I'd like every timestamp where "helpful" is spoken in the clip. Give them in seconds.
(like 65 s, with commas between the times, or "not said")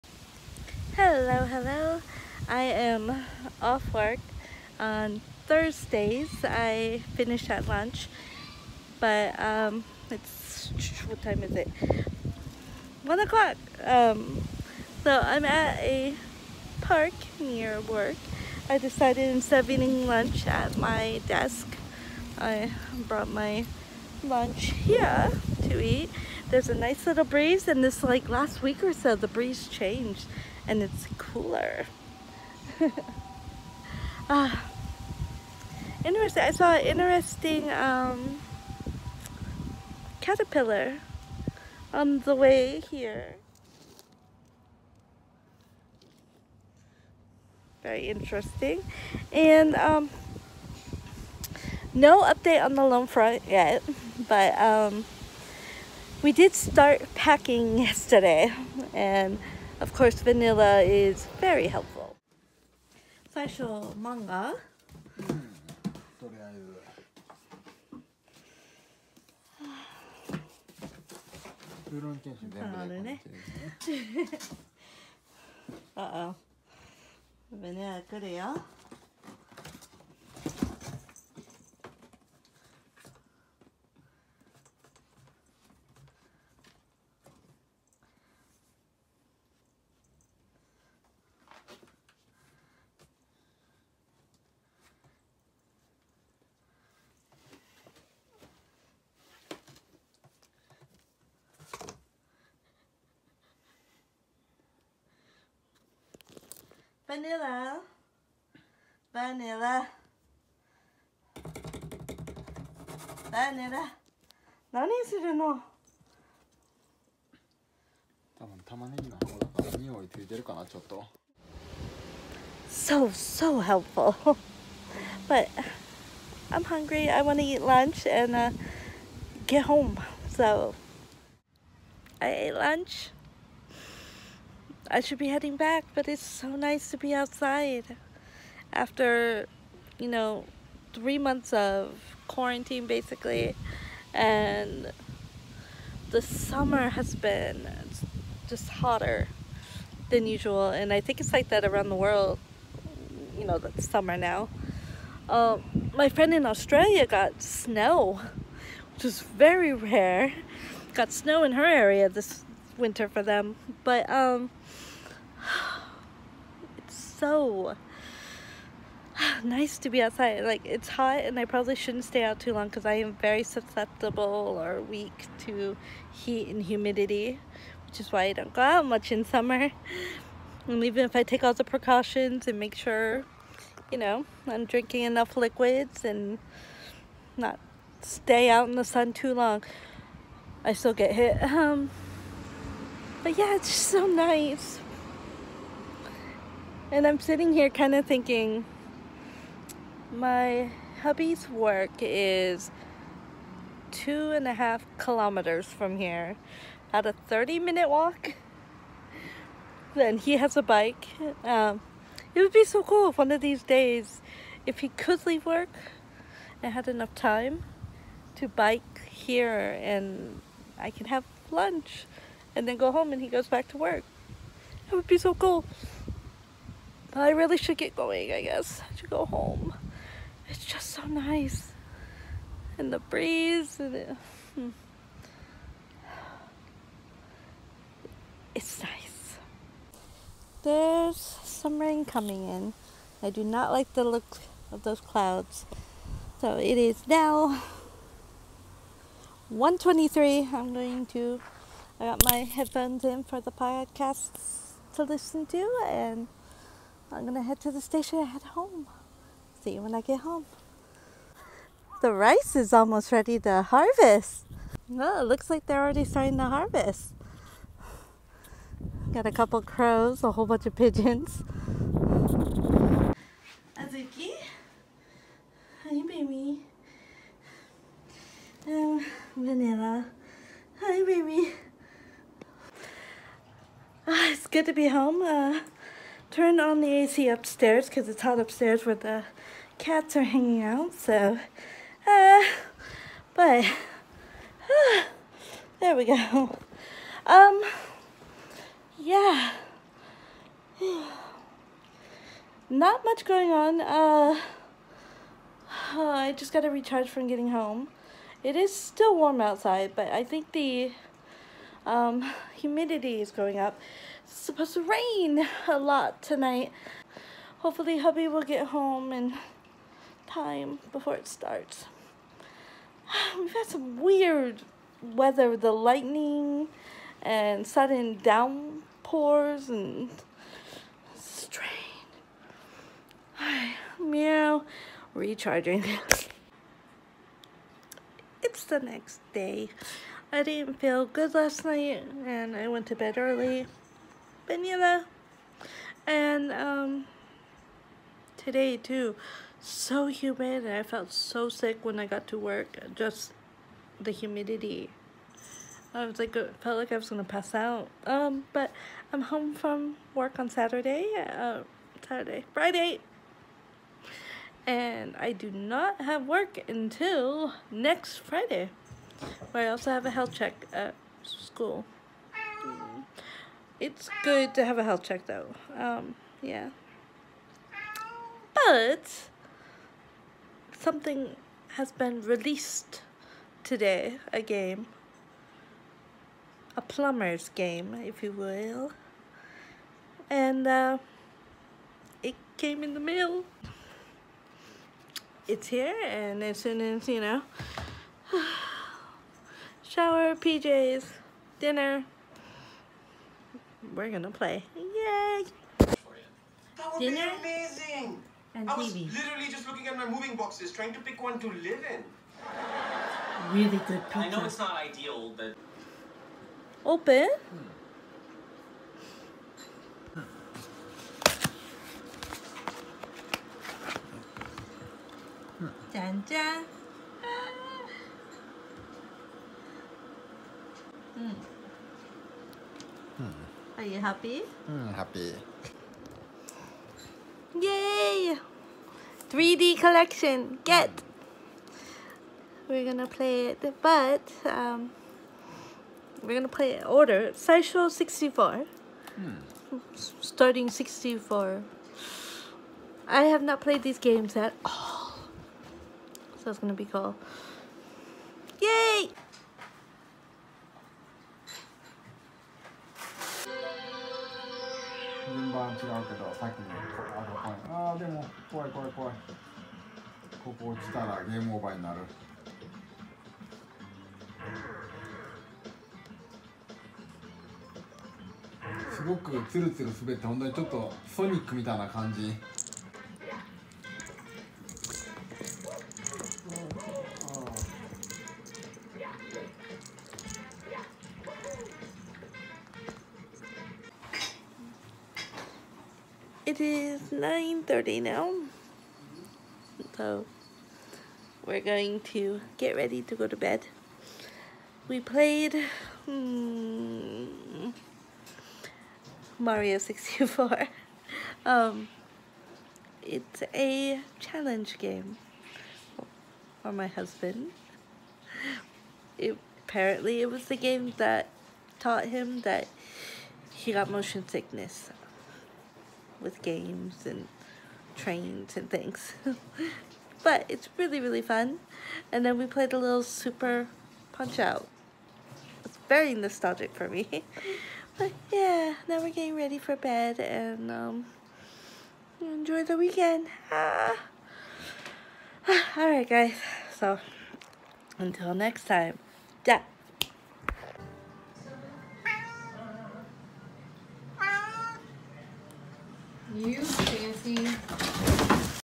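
61 s, 123 s.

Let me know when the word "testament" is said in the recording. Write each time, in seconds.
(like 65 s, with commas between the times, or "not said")
not said.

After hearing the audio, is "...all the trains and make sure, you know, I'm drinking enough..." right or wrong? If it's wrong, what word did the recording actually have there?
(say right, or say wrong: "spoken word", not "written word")
wrong: "precautions", not "trains".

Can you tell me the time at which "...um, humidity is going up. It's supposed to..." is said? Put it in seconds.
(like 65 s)
311 s.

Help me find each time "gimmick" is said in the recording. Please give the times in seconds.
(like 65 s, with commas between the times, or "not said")
not said.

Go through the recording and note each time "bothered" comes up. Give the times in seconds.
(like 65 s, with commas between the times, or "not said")
not said.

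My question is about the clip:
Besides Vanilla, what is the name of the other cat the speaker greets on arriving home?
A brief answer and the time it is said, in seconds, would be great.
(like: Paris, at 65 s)
Azuki, at 273 s.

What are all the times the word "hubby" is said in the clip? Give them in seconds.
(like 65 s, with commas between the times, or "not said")
201 s, 317 s.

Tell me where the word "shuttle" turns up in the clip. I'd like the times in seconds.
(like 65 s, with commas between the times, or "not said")
not said.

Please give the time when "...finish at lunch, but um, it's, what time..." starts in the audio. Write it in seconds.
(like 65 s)
7 s.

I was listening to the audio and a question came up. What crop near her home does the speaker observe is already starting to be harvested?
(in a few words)
Rice.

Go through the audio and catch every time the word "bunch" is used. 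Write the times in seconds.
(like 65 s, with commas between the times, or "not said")
270 s.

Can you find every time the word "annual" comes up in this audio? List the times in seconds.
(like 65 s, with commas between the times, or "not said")
not said.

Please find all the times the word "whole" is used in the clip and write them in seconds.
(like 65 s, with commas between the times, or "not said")
270 s.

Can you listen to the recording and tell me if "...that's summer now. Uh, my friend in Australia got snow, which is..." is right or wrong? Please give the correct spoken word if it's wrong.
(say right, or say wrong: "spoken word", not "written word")
right.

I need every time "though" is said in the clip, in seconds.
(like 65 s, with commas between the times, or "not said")
375 s.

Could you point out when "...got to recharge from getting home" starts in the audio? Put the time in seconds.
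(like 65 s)
306 s.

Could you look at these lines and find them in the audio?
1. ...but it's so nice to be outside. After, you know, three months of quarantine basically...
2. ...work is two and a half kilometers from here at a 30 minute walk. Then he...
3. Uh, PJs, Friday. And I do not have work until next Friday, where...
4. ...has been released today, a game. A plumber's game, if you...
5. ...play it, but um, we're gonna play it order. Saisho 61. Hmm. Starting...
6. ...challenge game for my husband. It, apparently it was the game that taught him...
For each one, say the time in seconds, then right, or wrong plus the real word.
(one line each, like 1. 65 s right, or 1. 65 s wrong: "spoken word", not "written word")
1. 135 s right
2. 201 s right
3. 361 s wrong: "Saturday", not "PJs"
4. 381 s right
5. 443 s wrong: "64", not "61"
6. 514 s right.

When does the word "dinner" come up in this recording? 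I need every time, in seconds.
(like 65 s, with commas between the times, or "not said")
401 s, 406 s.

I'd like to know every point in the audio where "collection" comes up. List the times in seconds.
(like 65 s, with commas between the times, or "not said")
439 s.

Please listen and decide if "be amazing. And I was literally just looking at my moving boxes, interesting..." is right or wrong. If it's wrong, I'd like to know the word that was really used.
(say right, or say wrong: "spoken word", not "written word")
wrong: "trying", not "interesting".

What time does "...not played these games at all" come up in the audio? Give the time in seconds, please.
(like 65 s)
453 s.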